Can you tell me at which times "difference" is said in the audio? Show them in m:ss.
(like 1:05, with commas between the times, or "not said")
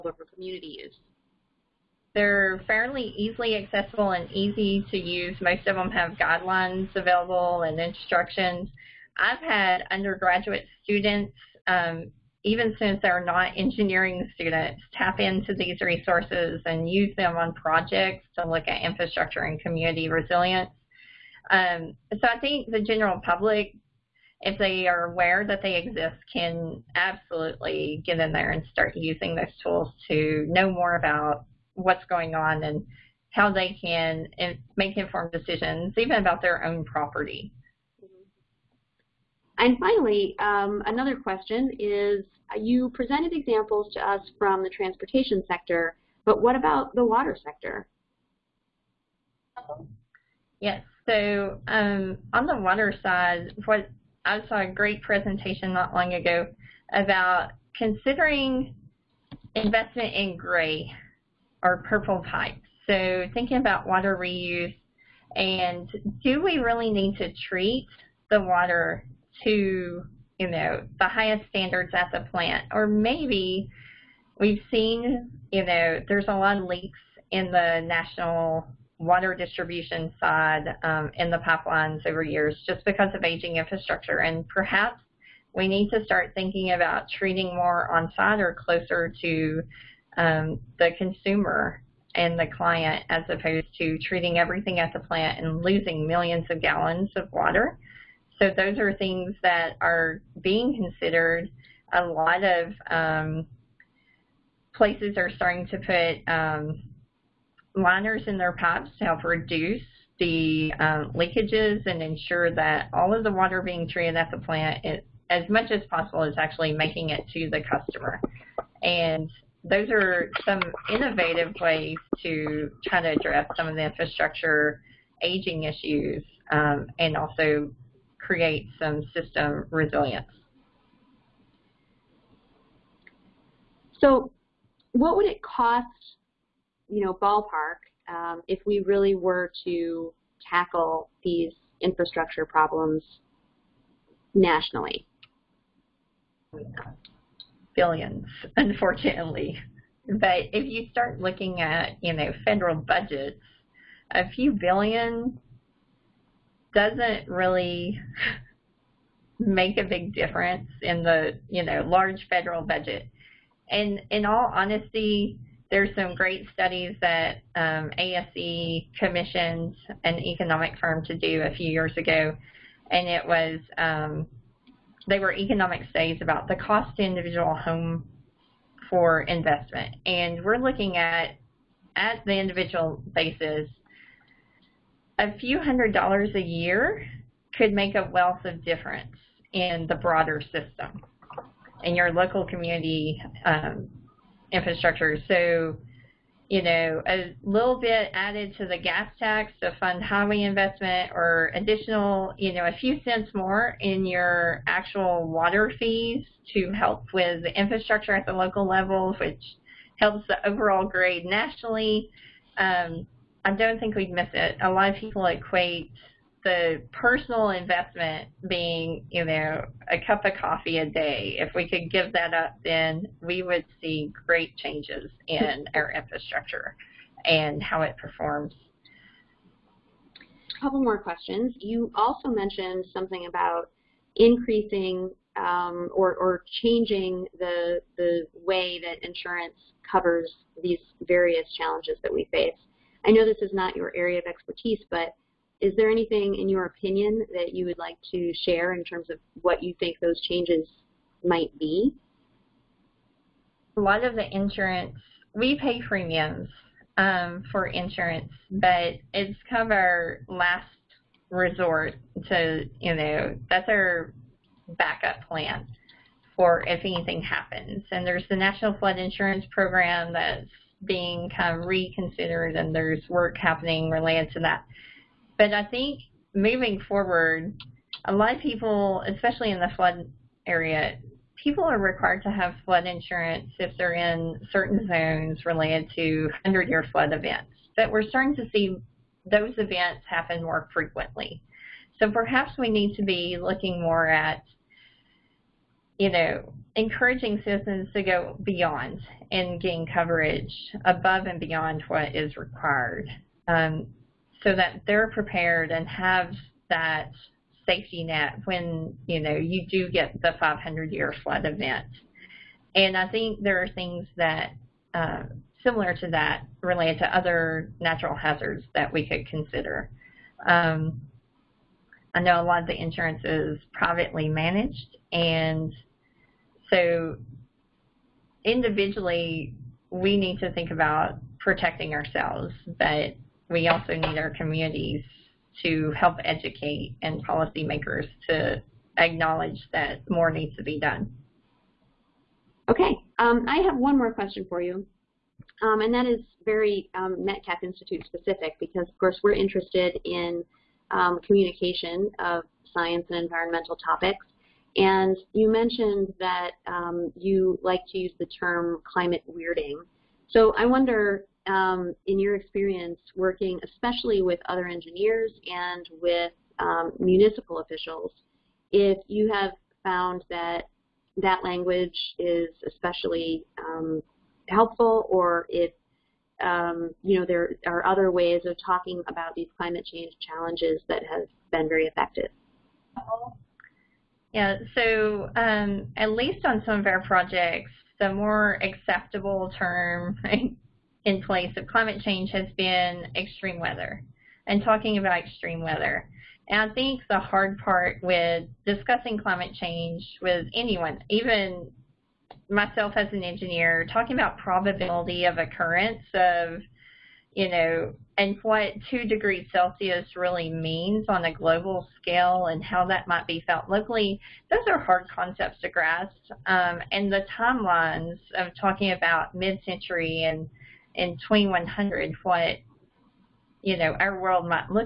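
2:40, 3:08.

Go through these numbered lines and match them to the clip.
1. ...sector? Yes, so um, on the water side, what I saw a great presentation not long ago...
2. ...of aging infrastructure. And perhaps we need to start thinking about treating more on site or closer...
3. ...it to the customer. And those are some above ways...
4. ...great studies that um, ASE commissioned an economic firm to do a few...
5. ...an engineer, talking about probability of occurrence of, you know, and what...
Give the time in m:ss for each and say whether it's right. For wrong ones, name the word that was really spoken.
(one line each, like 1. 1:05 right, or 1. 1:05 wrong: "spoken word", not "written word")
1. 0:47 right
2. 1:23 right
3. 1:57 wrong: "innovative", not "above"
4. 2:46 right
5. 6:43 right.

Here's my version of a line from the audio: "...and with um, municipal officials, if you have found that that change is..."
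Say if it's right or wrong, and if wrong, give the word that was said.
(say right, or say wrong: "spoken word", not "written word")
wrong: "language", not "change".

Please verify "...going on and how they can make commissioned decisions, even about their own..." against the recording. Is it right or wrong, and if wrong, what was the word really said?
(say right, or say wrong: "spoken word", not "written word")
wrong: "informed", not "commissioned".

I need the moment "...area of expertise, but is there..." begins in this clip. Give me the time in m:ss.
4:03.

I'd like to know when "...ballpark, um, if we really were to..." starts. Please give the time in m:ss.
2:17.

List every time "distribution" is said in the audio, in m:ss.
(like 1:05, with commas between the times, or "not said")
1:19.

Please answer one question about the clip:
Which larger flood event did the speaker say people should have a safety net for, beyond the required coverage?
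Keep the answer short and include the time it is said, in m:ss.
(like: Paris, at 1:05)
500-year flood event, at 5:10.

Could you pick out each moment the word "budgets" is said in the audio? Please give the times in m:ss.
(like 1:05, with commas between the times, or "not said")
2:32, 2:42.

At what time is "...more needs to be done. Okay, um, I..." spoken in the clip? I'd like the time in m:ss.
5:40.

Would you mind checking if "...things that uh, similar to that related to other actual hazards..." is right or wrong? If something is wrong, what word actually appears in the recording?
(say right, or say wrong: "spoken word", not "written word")
wrong: "natural", not "actual".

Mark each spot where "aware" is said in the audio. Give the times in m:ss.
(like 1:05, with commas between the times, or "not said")
0:25.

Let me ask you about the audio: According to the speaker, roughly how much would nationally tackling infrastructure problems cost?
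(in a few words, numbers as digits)
Billions.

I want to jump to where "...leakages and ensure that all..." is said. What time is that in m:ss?
1:51.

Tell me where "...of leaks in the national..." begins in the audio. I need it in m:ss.
1:16.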